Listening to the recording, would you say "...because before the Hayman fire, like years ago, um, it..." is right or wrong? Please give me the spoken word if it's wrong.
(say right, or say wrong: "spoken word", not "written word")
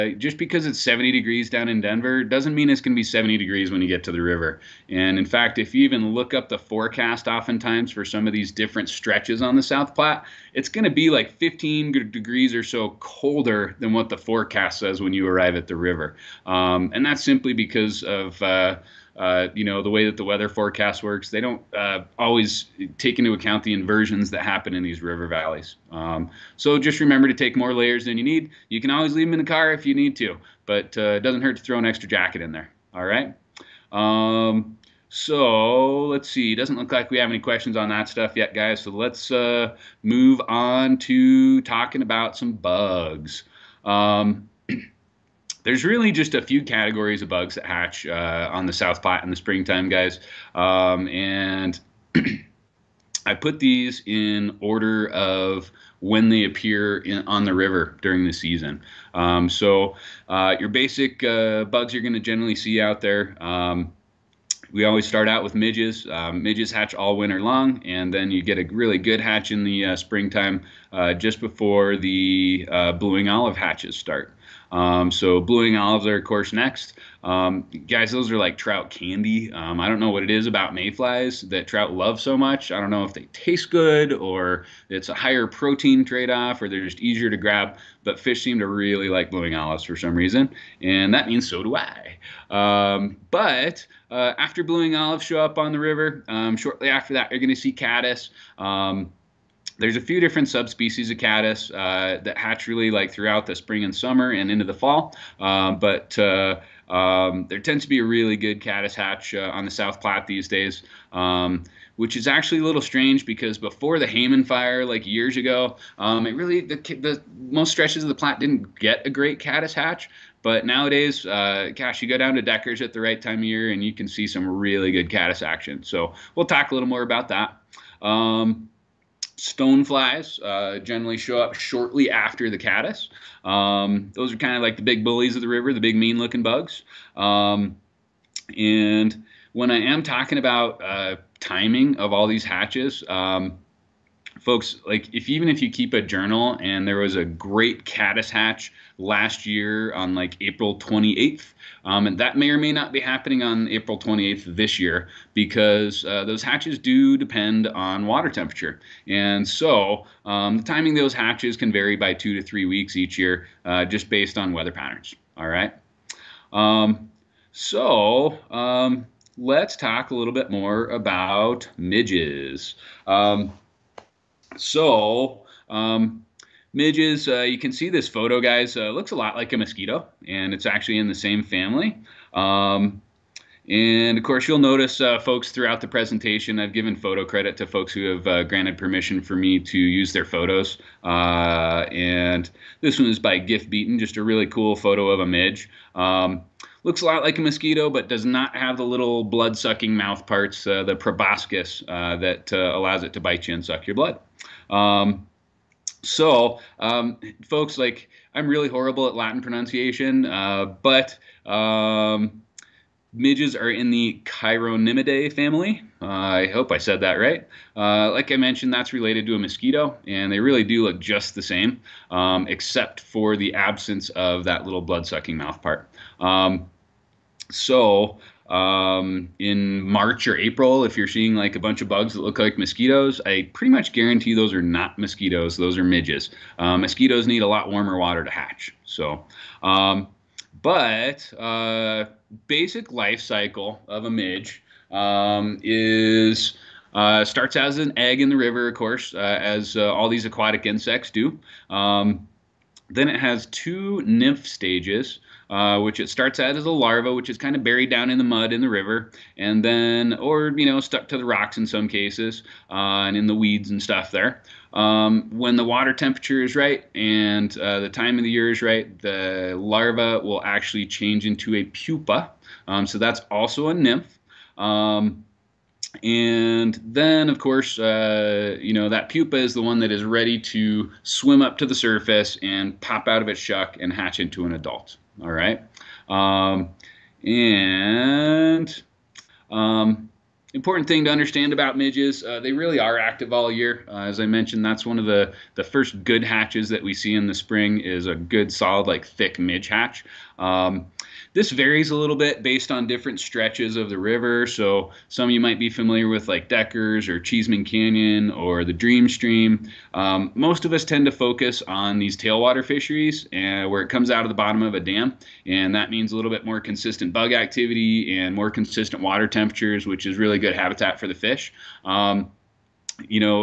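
right.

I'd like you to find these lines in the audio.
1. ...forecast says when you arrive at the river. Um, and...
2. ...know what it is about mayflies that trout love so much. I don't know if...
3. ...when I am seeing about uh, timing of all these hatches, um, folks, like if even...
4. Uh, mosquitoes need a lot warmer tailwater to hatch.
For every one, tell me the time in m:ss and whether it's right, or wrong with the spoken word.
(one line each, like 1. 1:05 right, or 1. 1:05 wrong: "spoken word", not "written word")
1. 0:14 right
2. 1:19 right
3. 2:19 wrong: "talking", not "seeing"
4. 3:56 wrong: "water", not "tailwater".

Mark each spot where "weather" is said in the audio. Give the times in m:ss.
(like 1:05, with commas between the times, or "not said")
0:20, 2:44.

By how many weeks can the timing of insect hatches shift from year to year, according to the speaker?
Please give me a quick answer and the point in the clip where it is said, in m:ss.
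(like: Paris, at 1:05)
2 to 3 weeks, at 2:42.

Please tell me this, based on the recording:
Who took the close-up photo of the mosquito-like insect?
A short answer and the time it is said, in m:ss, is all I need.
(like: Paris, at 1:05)
Gift Beaton, at 3:13.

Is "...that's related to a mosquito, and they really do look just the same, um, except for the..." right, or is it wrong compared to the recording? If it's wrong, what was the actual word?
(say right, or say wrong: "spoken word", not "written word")
right.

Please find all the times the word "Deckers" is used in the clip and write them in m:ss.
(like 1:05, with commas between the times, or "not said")
2:02, 5:06.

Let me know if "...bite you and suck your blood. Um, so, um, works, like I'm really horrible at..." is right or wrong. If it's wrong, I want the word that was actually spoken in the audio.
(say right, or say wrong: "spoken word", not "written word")
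wrong: "folks", not "works".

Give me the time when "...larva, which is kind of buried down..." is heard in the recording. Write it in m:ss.
4:16.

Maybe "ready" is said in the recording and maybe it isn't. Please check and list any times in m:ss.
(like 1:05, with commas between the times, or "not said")
4:40.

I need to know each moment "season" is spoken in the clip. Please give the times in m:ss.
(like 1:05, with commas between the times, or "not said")
0:58.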